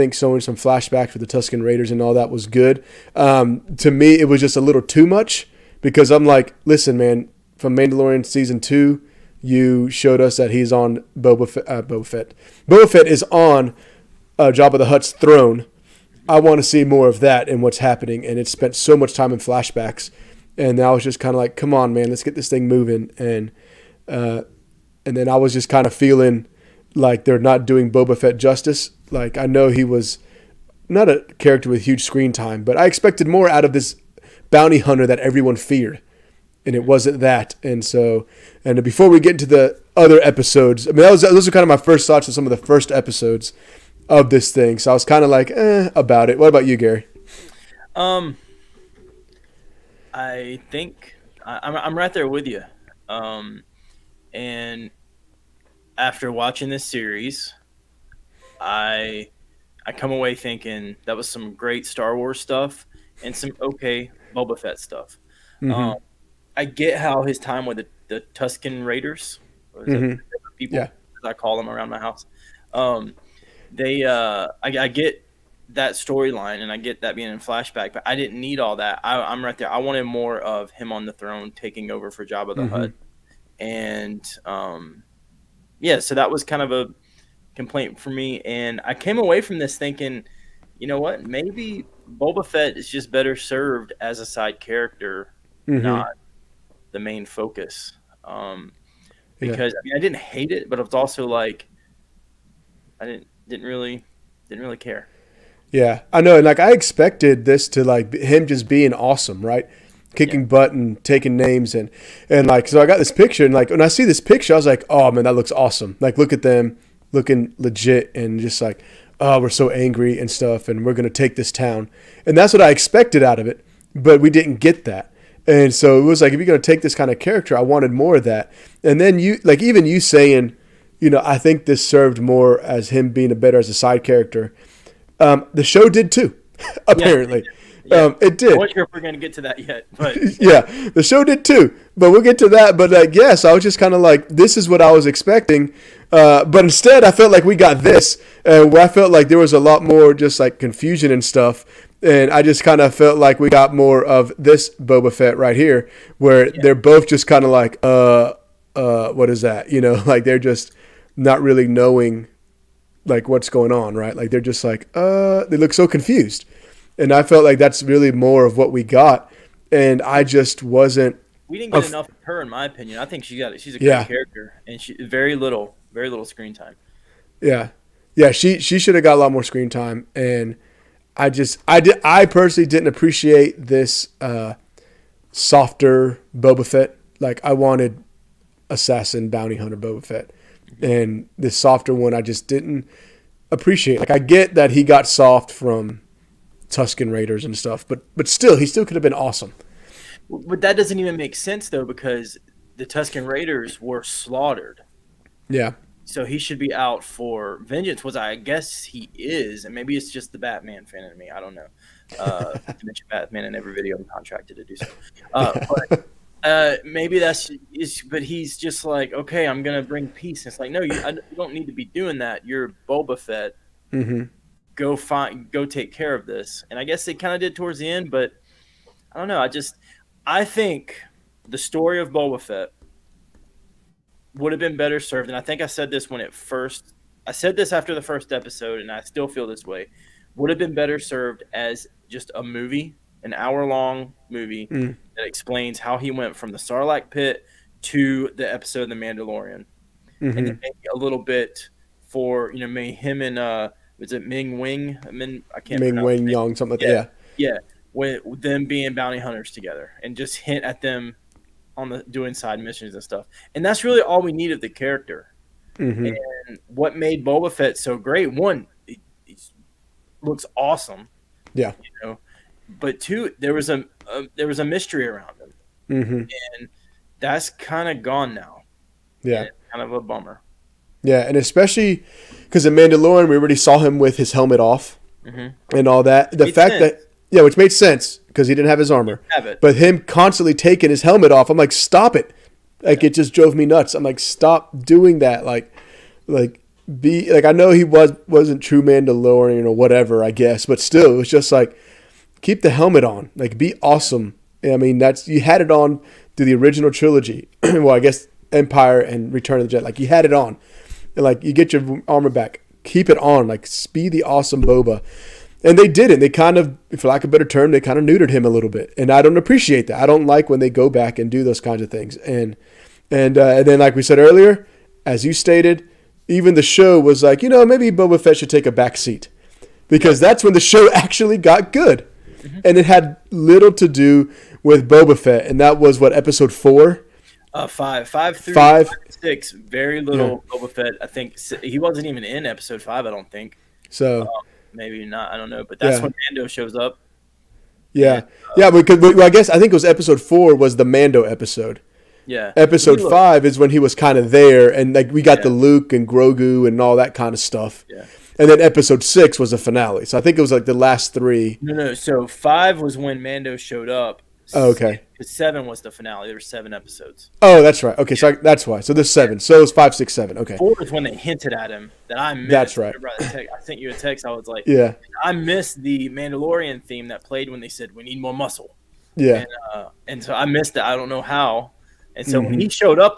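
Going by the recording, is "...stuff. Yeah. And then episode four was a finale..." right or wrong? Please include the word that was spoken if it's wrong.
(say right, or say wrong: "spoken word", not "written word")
wrong: "six", not "four".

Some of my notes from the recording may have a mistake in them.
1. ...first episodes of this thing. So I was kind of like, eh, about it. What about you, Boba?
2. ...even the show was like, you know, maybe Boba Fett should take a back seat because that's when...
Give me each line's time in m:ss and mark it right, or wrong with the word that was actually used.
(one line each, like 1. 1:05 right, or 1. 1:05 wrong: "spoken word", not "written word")
1. 0:42 wrong: "Gary", not "Boba"
2. 5:26 right.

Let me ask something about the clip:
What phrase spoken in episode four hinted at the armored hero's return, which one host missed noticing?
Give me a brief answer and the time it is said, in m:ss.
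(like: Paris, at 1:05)
we need more muscle, at 6:17.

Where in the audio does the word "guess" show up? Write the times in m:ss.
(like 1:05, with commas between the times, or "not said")
3:28, 3:46, 5:00, 5:07, 5:49.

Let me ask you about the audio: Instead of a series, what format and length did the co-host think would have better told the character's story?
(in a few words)
an hour long movie.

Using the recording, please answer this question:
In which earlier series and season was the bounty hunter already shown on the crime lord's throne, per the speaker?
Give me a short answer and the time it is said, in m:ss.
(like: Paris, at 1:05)
Mandalorian season two, at 0:07.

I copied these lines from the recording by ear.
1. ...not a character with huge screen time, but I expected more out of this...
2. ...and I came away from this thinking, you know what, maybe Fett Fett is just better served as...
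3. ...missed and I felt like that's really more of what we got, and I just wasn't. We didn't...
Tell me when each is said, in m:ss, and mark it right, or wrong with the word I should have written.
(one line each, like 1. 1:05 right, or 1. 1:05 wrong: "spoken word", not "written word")
1. 0:30 right
2. 1:28 wrong: "Boba", not "Fett"
3. 2:45 wrong: "confused", not "missed".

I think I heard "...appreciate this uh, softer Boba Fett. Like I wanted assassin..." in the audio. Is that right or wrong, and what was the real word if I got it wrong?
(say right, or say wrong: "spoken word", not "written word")
right.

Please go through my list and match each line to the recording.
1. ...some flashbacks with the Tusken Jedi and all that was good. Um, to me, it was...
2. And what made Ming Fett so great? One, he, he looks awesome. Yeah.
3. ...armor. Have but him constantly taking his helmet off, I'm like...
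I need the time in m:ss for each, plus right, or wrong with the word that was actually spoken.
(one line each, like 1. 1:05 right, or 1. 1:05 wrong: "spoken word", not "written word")
1. 0:00 wrong: "Raiders", not "Jedi"
2. 4:26 wrong: "Boba", not "Ming"
3. 4:48 right.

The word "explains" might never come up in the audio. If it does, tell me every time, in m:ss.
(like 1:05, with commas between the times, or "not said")
4:05.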